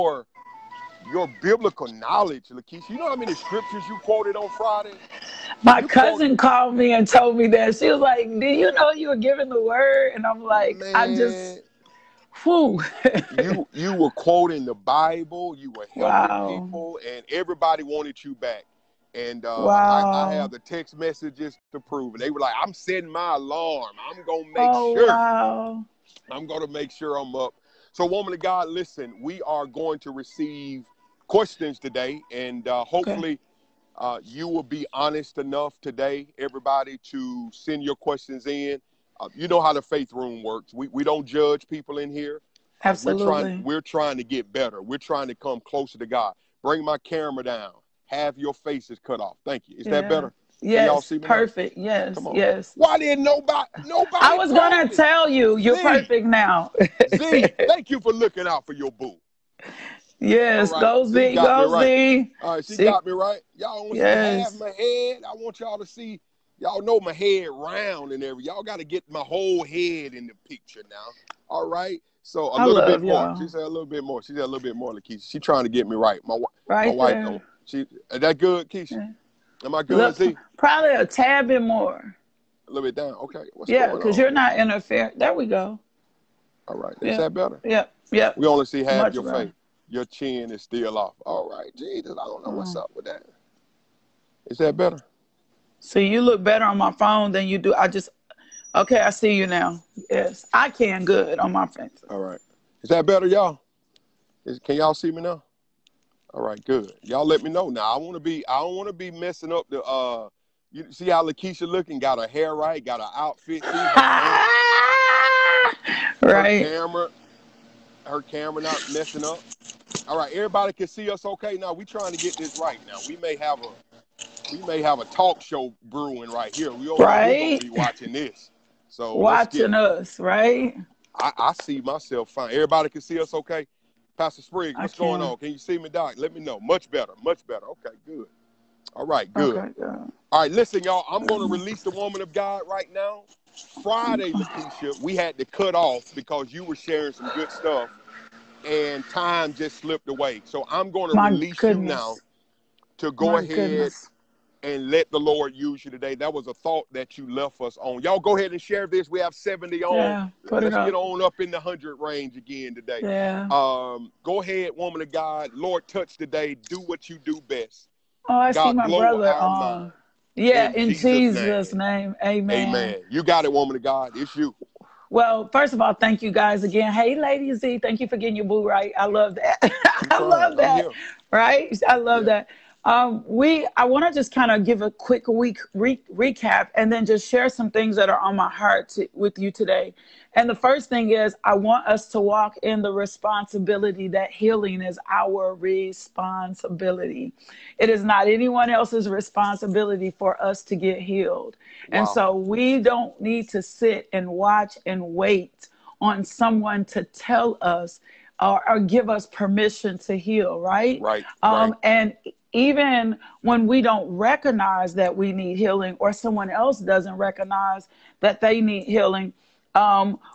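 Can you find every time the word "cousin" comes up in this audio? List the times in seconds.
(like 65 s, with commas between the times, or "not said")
5 s.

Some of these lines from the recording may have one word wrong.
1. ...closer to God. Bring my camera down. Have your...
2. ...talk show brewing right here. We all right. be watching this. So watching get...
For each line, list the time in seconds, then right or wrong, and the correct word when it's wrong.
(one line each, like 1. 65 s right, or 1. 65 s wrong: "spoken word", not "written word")
1. 45 s right
2. 125 s right.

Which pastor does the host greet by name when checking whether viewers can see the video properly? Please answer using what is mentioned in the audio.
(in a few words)
Pastor Spriggs.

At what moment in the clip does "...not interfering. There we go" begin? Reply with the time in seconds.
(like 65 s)
84 s.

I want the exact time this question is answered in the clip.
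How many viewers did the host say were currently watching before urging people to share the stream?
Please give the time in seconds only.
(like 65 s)
159 s.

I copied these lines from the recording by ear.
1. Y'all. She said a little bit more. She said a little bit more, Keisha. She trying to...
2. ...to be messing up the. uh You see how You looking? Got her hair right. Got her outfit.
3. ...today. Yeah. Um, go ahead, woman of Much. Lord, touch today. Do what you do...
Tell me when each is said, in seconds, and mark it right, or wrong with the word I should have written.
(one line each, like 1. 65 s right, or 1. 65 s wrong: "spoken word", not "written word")
1. 73 s wrong: "LaKisha", not "Keisha"
2. 108 s wrong: "LaKisha", not "You"
3. 162 s wrong: "God", not "Much".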